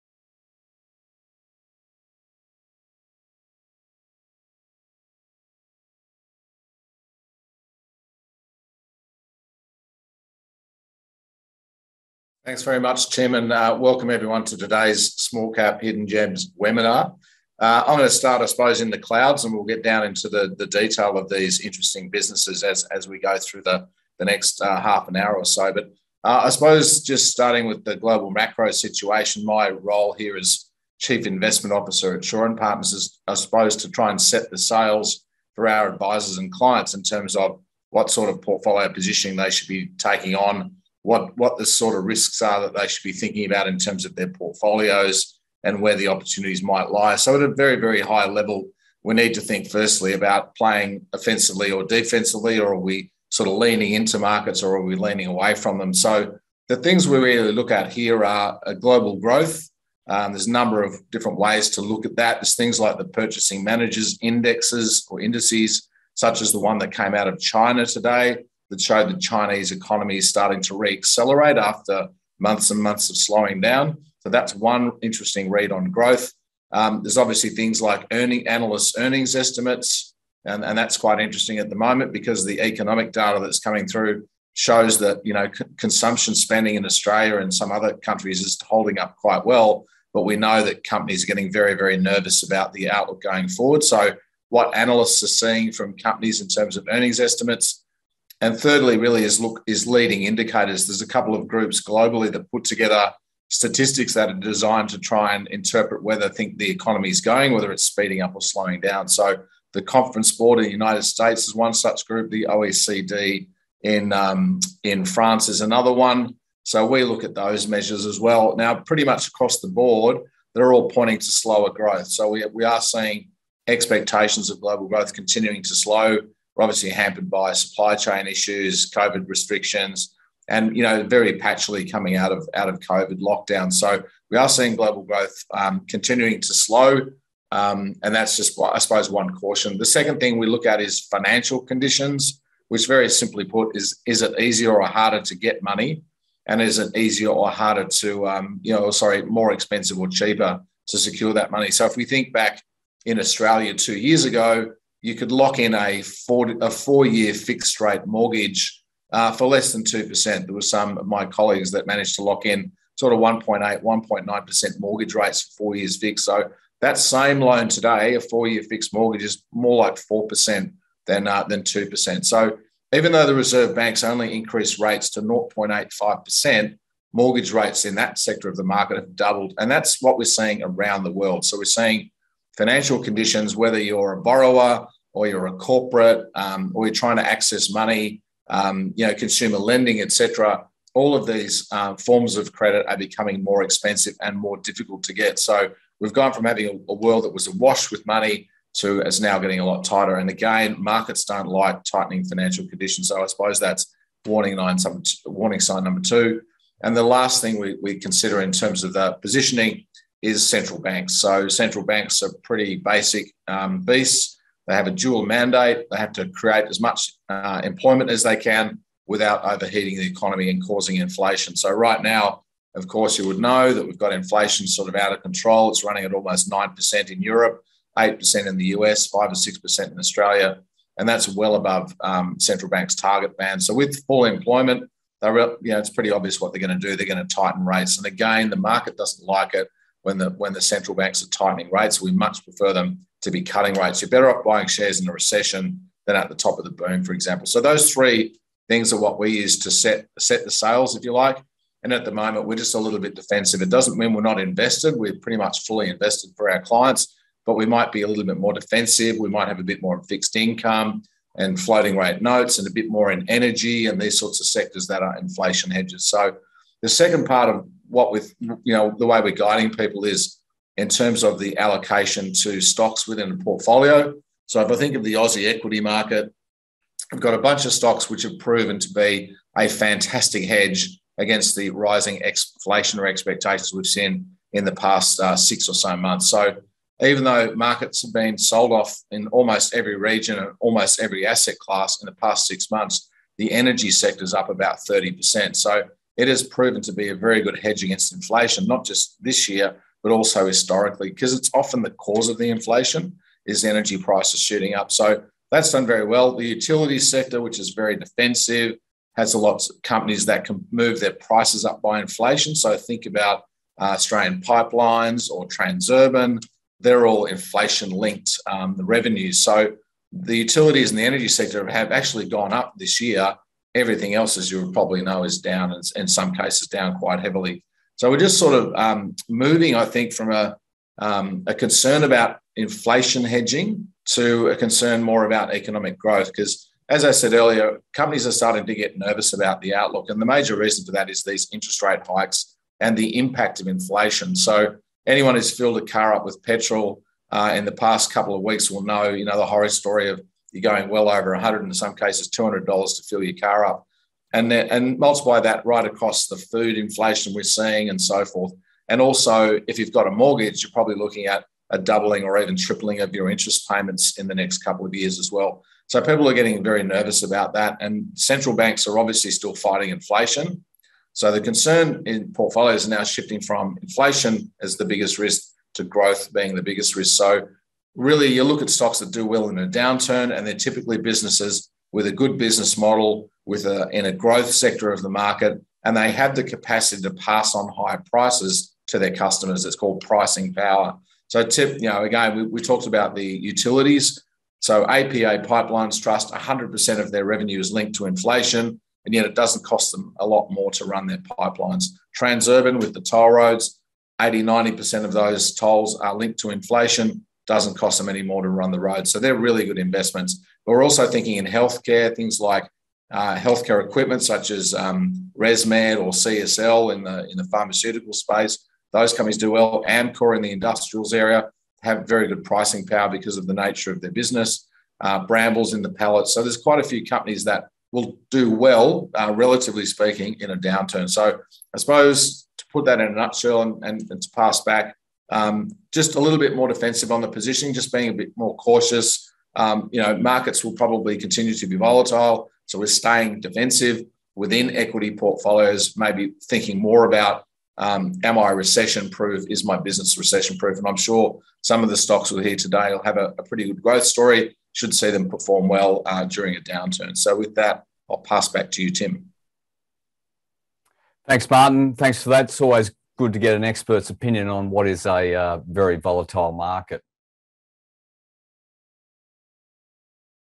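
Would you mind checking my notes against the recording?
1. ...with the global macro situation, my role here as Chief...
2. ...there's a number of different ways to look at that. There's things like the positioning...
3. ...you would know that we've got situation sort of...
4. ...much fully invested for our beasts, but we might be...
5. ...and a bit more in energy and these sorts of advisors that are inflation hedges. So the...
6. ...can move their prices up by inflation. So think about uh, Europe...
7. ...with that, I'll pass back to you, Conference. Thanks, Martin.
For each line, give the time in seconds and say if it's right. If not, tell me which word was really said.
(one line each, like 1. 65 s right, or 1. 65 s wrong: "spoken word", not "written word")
1. 27 s right
2. 60 s wrong: "purchasing", not "positioning"
3. 223 s wrong: "inflation", not "situation"
4. 255 s wrong: "clients", not "beasts"
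5. 262 s wrong: "sectors", not "advisors"
6. 310 s wrong: "Australian", not "Europe"
7. 457 s wrong: "Tim", not "Conference".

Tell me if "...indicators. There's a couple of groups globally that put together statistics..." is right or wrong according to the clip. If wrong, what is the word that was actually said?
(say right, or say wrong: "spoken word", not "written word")
right.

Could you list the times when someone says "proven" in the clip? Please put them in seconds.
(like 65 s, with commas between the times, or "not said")
278 s, 296 s.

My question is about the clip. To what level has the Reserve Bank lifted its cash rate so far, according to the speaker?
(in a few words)
0.85%.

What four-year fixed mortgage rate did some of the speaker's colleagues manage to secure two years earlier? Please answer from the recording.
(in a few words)
1.8%.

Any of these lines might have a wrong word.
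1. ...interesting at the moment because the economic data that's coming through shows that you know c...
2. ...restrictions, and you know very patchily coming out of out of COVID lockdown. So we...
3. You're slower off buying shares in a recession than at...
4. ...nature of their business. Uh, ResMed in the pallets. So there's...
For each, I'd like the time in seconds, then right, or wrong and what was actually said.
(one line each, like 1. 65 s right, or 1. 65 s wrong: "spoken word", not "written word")
1. 81 s right
2. 129 s right
3. 244 s wrong: "better", not "slower"
4. 423 s wrong: "Brambles", not "ResMed".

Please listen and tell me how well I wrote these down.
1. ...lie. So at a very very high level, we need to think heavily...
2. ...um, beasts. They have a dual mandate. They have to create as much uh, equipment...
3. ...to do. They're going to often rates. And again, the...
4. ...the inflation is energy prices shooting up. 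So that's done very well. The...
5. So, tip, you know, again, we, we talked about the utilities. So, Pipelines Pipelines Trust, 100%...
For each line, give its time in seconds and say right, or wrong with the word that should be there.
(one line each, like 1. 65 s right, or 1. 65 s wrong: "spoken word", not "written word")
1. 46 s wrong: "firstly", not "heavily"
2. 213 s wrong: "employment", not "equipment"
3. 236 s wrong: "tighten", not "often"
4. 302 s right
5. 391 s wrong: "APA", not "Pipelines".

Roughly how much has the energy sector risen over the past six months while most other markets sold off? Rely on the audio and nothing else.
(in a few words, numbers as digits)
30%.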